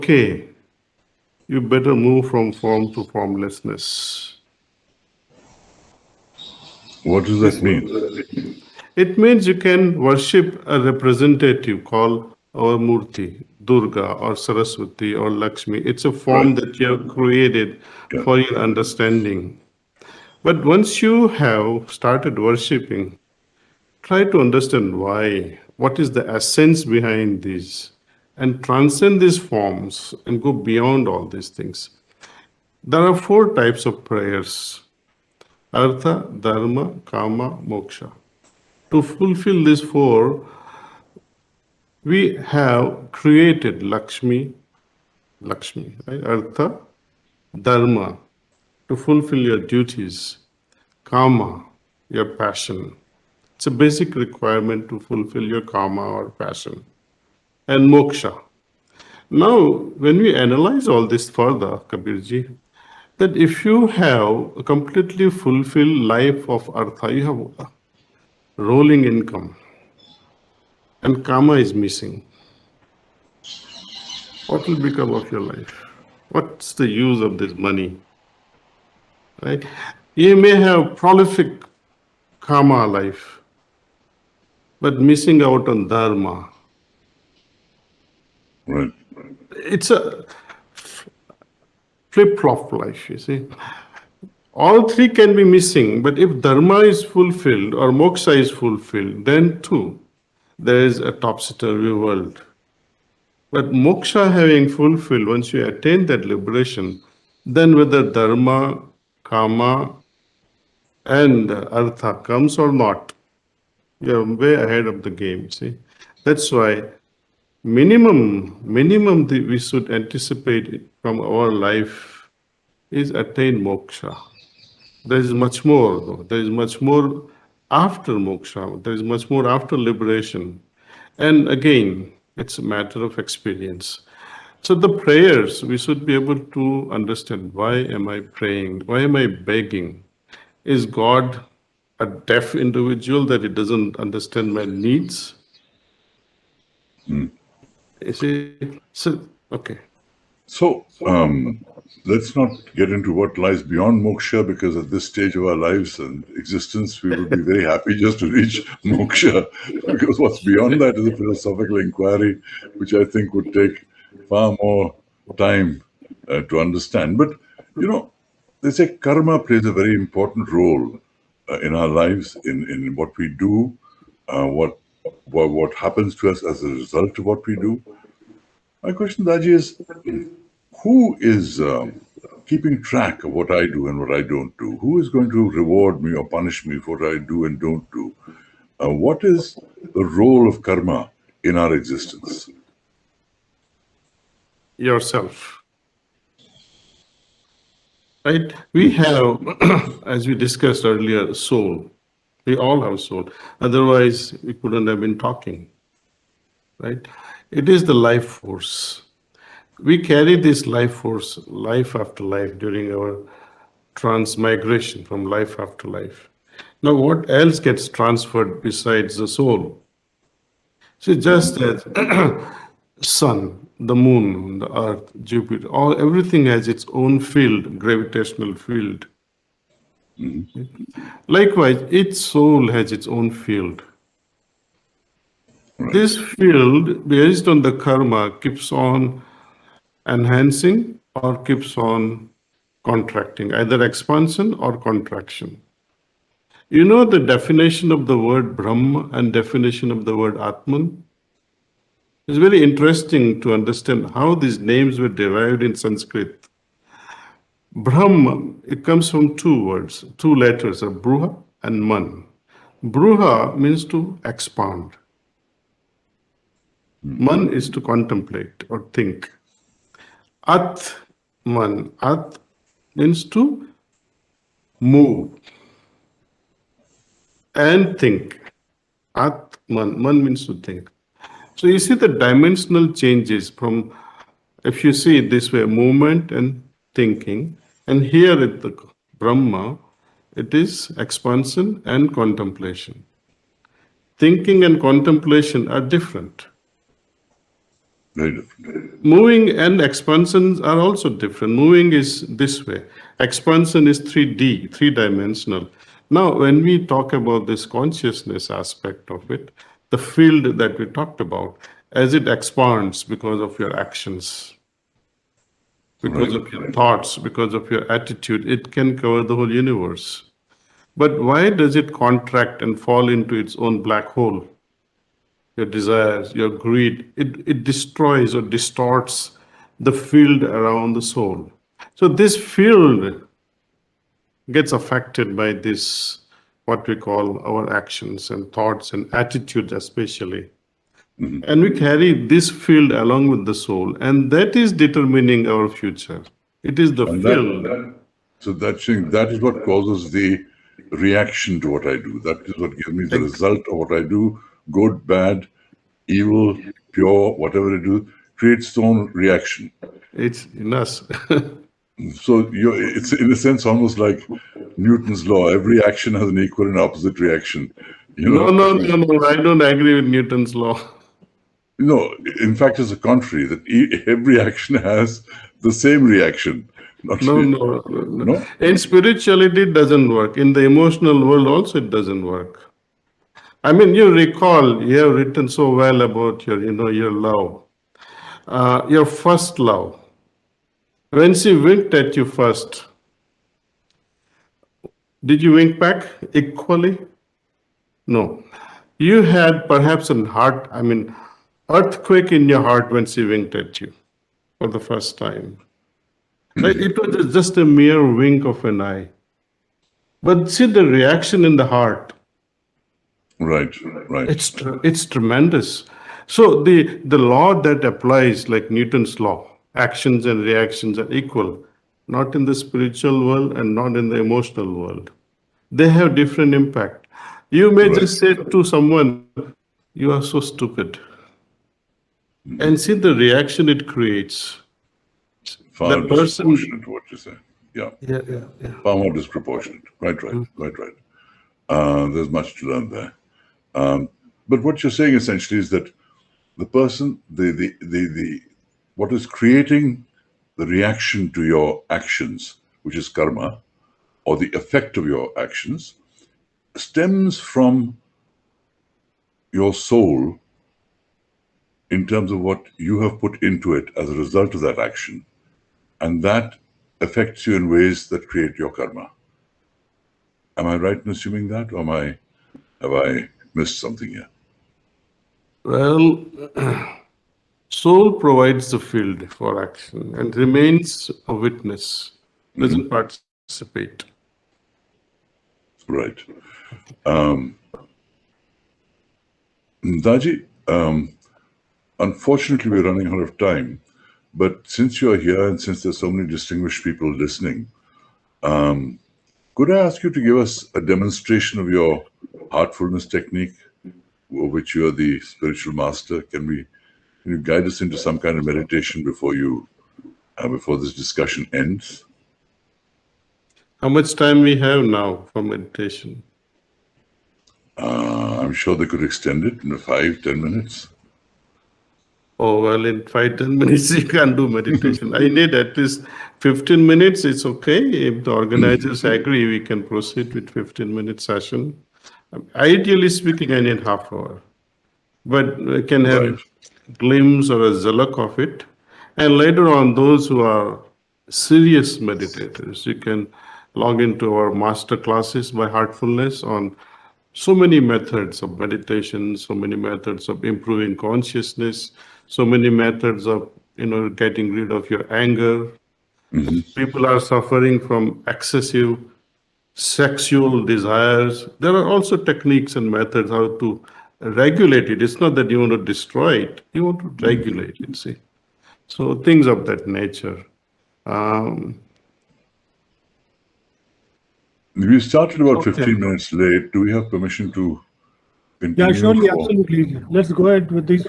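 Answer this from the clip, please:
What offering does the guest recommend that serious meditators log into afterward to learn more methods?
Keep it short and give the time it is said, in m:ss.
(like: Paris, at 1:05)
Master classes, at 9:04.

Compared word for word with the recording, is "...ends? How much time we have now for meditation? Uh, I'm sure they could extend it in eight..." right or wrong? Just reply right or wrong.
wrong.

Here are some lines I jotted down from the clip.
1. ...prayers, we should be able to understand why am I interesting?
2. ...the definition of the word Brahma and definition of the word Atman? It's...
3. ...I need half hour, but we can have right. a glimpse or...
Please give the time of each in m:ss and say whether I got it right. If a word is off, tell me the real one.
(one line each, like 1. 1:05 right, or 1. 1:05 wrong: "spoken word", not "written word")
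1. 2:14 wrong: "praying", not "interesting"
2. 4:07 right
3. 8:53 right.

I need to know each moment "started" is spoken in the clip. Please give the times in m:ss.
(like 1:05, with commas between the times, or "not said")
0:21, 9:34.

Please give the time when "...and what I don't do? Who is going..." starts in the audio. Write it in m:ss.
3:03.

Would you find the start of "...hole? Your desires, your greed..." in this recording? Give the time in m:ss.
5:24.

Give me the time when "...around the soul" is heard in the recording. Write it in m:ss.
5:30.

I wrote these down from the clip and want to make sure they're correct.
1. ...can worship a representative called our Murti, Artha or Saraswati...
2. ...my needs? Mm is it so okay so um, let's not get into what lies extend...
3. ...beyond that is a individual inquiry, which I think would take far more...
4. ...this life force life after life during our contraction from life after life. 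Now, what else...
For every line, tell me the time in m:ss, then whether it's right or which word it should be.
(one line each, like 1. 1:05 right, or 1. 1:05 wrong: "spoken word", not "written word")
1. 0:09 wrong: "Durga", not "Artha"
2. 2:24 wrong: "beyond", not "extend"
3. 2:40 wrong: "philosophical", not "individual"
4. 3:30 wrong: "transmigration", not "contraction".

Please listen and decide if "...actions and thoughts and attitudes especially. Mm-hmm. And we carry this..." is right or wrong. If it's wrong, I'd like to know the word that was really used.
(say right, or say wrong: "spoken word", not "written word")
right.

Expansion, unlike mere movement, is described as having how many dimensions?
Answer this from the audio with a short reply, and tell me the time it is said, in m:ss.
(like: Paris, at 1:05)
3, at 5:04.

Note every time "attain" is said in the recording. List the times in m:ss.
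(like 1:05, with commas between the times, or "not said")
1:45, 2:03.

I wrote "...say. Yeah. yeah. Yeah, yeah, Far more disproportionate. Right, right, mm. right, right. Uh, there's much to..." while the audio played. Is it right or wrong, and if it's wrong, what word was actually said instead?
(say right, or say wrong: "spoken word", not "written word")
right.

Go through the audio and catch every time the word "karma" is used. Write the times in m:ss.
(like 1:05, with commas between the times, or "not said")
2:48, 3:10, 3:57, 7:33, 7:48.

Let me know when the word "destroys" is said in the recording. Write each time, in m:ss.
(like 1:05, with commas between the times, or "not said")
5:27, 9:25.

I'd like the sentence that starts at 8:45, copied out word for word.
I need at least 15 minutes.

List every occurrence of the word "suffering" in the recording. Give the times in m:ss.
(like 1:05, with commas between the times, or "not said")
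9:17.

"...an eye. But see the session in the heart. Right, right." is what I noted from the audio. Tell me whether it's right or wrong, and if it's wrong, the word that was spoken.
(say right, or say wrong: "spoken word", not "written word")
wrong: "reaction", not "session".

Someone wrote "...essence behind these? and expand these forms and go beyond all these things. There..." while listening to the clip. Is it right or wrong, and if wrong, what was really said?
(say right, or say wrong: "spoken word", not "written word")
wrong: "transcend", not "expand".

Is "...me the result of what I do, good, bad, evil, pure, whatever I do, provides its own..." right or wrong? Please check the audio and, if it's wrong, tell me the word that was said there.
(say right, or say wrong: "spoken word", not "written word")
wrong: "creates", not "provides".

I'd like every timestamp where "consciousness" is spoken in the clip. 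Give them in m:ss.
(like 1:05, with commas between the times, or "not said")
5:07, 9:10.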